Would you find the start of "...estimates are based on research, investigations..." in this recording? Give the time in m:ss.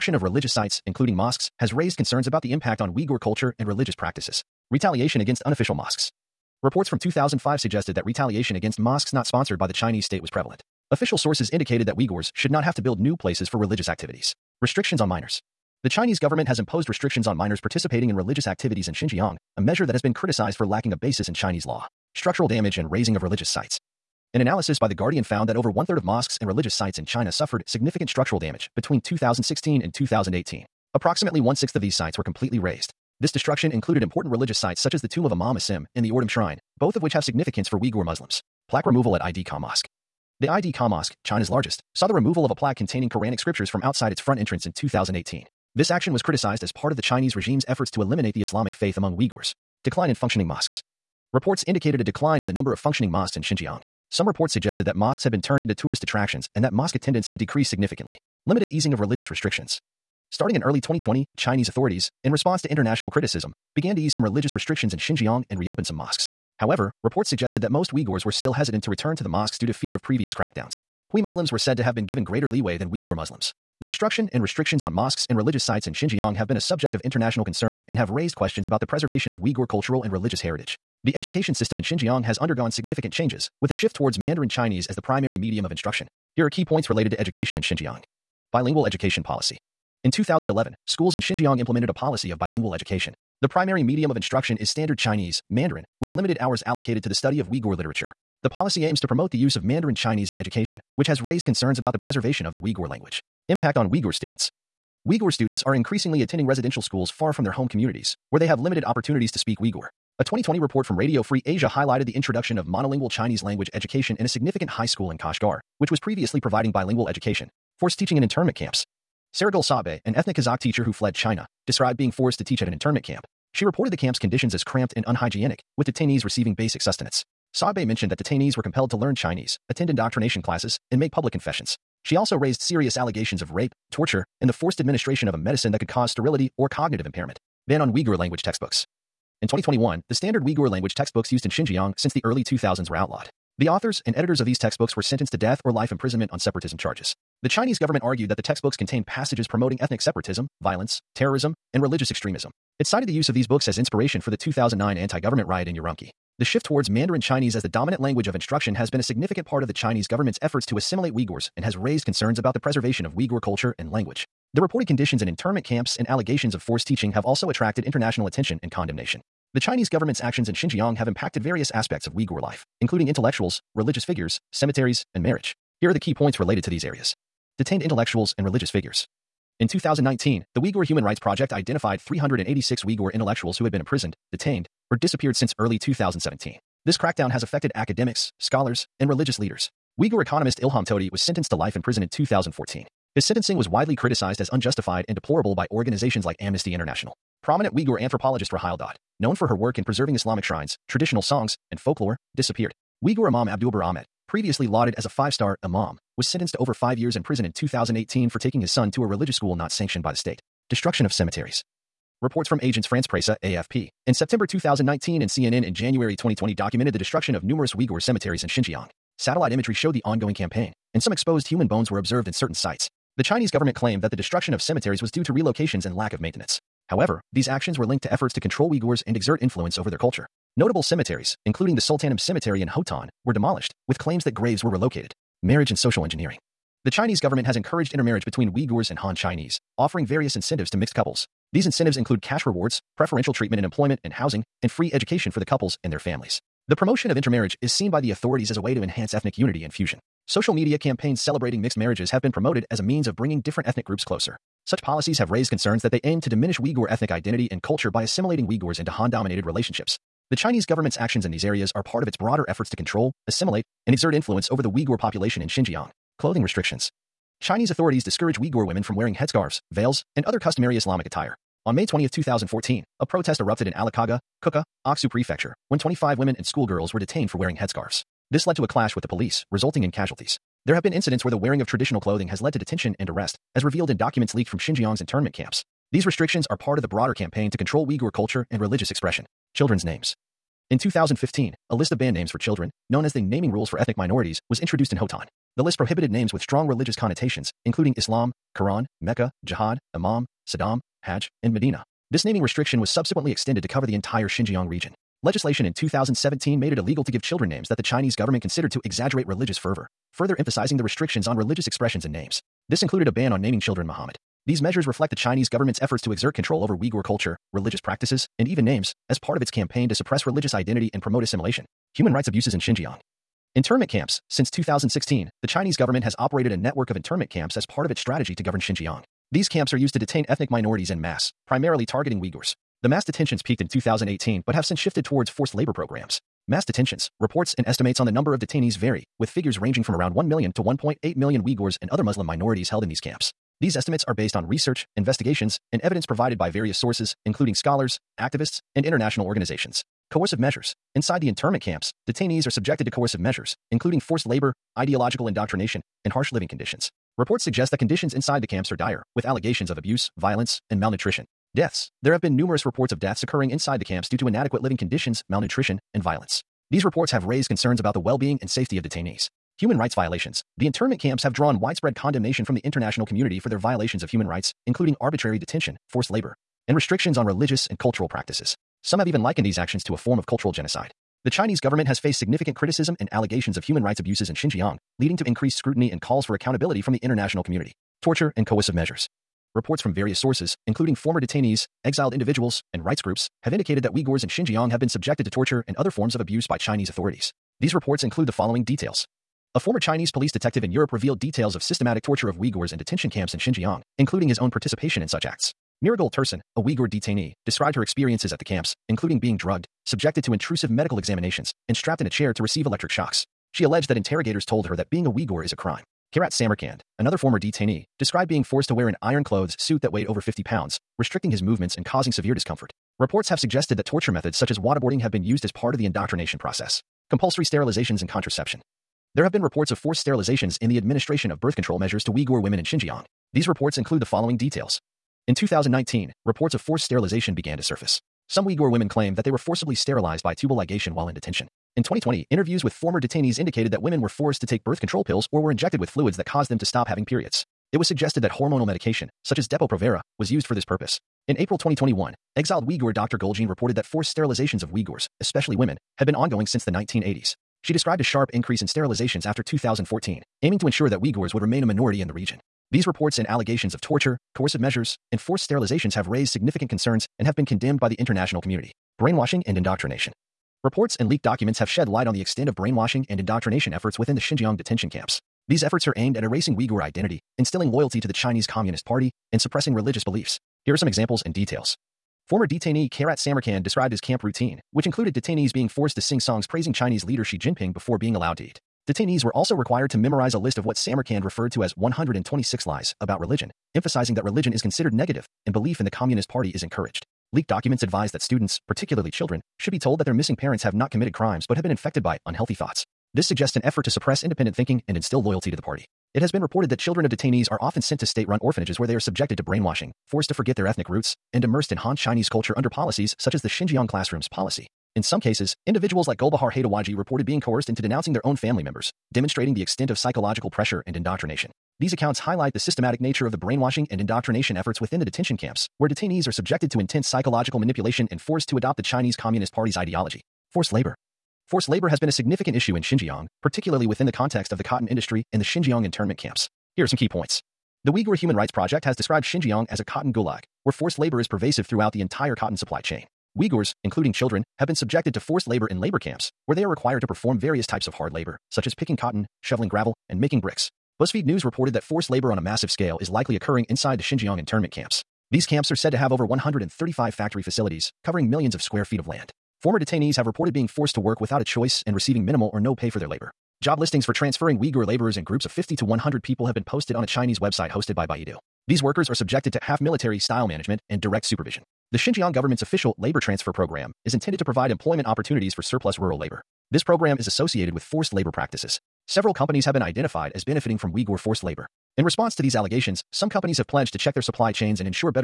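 5:43.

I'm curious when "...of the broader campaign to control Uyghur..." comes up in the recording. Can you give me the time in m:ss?
4:46.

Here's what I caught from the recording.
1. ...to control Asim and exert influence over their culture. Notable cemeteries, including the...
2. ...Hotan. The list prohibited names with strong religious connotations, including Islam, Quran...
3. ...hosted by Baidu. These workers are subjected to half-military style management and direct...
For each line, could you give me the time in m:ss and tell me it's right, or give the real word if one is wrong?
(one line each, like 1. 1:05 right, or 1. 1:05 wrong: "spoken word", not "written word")
1. 3:48 wrong: "Uyghurs", not "Asim"
2. 4:54 right
3. 9:27 right.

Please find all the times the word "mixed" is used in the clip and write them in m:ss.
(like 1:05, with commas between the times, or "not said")
4:00, 4:11.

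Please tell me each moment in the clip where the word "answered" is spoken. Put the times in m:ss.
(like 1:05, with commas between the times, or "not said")
not said.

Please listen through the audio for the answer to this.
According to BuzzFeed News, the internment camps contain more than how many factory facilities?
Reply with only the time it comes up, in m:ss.
9:16.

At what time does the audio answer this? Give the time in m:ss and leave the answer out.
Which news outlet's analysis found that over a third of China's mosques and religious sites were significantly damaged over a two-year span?
0:24.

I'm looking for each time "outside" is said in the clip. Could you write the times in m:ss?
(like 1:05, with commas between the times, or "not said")
0:43.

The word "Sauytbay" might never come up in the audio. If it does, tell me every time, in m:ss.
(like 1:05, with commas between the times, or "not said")
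1:59, 2:07.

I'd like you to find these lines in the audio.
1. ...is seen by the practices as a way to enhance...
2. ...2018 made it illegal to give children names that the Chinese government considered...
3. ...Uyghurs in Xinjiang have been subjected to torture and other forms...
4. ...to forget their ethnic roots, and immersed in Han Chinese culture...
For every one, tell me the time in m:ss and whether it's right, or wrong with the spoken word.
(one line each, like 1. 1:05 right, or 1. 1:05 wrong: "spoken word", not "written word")
1. 4:07 wrong: "authorities", not "practices"
2. 5:05 wrong: "2017", not "2018"
3. 6:33 right
4. 8:30 right.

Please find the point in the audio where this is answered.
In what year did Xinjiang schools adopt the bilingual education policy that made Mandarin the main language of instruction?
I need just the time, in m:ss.
1:30.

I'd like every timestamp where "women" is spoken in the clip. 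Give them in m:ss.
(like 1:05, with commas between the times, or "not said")
4:28, 4:36, 7:12, 7:18, 7:23, 7:35.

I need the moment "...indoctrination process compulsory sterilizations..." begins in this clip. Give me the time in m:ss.
7:05.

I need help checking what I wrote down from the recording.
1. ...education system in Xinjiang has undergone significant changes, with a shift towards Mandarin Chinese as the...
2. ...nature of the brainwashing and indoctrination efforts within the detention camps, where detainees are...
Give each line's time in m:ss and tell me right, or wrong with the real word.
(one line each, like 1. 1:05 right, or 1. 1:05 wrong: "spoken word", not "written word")
1. 1:21 right
2. 8:43 right.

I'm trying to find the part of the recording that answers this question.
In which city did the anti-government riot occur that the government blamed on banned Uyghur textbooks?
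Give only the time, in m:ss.
2:35.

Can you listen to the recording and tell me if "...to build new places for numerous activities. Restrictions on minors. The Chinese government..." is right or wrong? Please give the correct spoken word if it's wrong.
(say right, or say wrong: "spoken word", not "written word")
wrong: "religious", not "numerous".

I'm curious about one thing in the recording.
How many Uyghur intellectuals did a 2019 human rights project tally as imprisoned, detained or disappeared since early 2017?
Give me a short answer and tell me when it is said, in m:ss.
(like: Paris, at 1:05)
386, at 3:01.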